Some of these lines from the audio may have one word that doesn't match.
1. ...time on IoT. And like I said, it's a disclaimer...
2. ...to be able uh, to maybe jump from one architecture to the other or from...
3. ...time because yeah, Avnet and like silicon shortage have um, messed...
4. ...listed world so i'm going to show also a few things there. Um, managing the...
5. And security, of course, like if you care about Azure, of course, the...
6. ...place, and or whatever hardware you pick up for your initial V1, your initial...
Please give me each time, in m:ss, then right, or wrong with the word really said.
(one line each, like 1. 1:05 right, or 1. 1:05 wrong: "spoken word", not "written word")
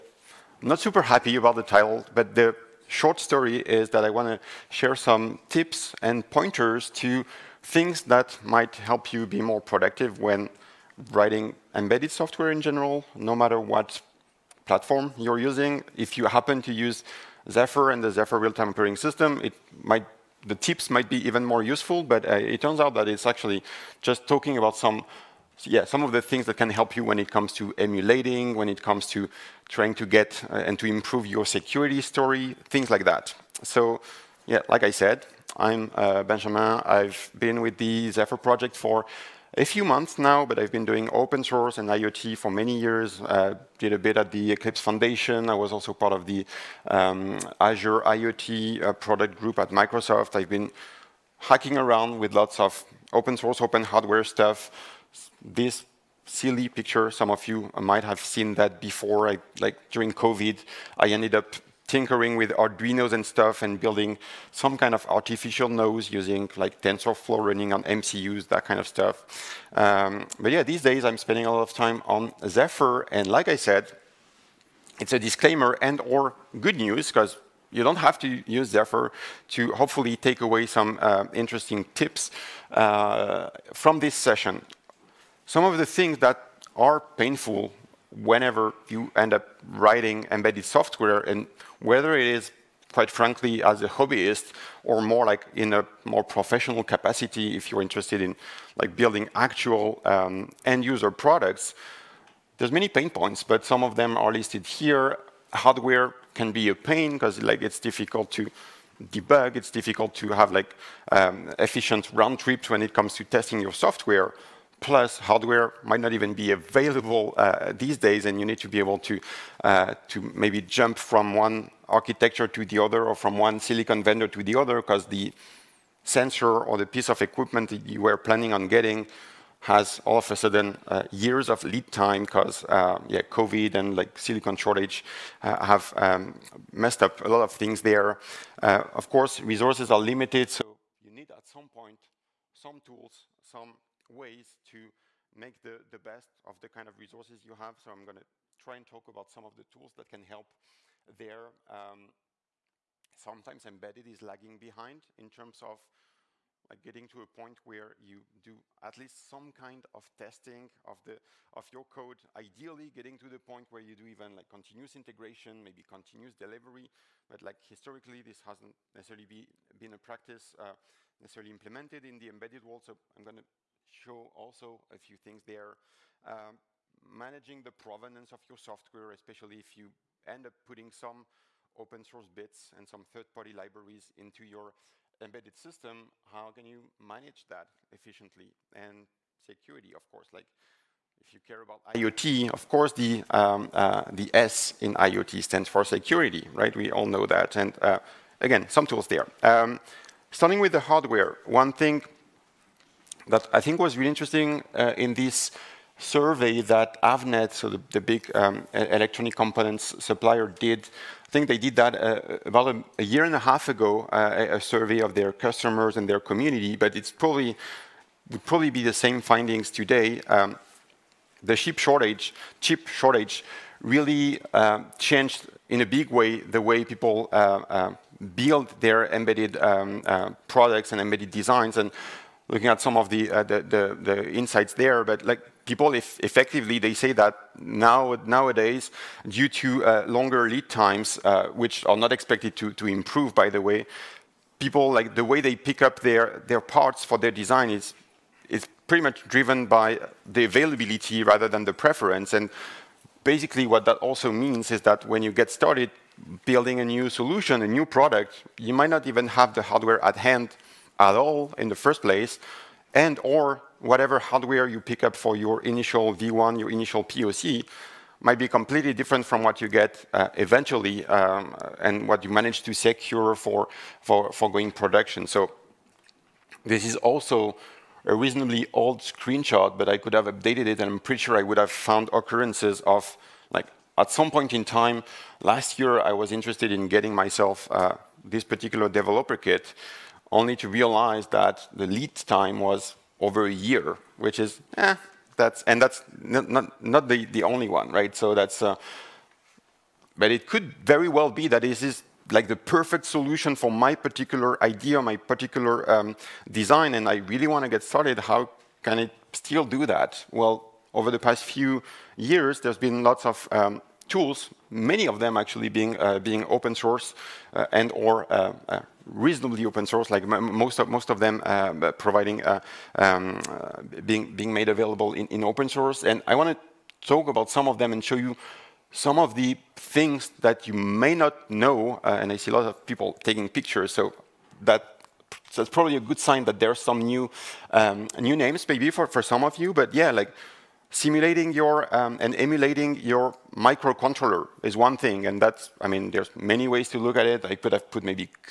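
1. 1:11 wrong: "Zephyr", not "IoT"
2. 1:58 right
3. 2:11 wrong: "COVID", not "Avnet"
4. 2:52 wrong: "embedded", not "listed"
5. 3:08 wrong: "IoT", not "Azure"
6. 4:22 right.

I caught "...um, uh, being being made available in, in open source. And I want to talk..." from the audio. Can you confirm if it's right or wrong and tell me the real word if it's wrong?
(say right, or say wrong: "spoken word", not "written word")
right.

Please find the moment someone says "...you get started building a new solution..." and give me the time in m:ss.
4:15.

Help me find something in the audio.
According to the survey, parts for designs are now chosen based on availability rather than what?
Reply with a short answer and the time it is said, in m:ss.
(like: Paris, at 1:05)
preference, at 4:11.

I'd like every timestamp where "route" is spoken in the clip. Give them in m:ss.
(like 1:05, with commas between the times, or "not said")
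not said.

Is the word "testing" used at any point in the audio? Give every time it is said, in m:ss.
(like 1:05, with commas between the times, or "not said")
1:53, 2:40.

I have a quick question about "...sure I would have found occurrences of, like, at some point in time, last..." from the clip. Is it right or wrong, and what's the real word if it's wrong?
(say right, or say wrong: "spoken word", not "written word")
right.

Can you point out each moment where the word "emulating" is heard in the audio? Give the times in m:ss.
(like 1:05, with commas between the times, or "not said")
0:27, 5:42.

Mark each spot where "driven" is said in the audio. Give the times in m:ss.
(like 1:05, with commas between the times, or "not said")
4:09.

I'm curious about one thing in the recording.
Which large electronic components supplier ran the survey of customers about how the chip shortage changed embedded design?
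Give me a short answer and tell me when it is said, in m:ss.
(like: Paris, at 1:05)
Avnet, at 3:27.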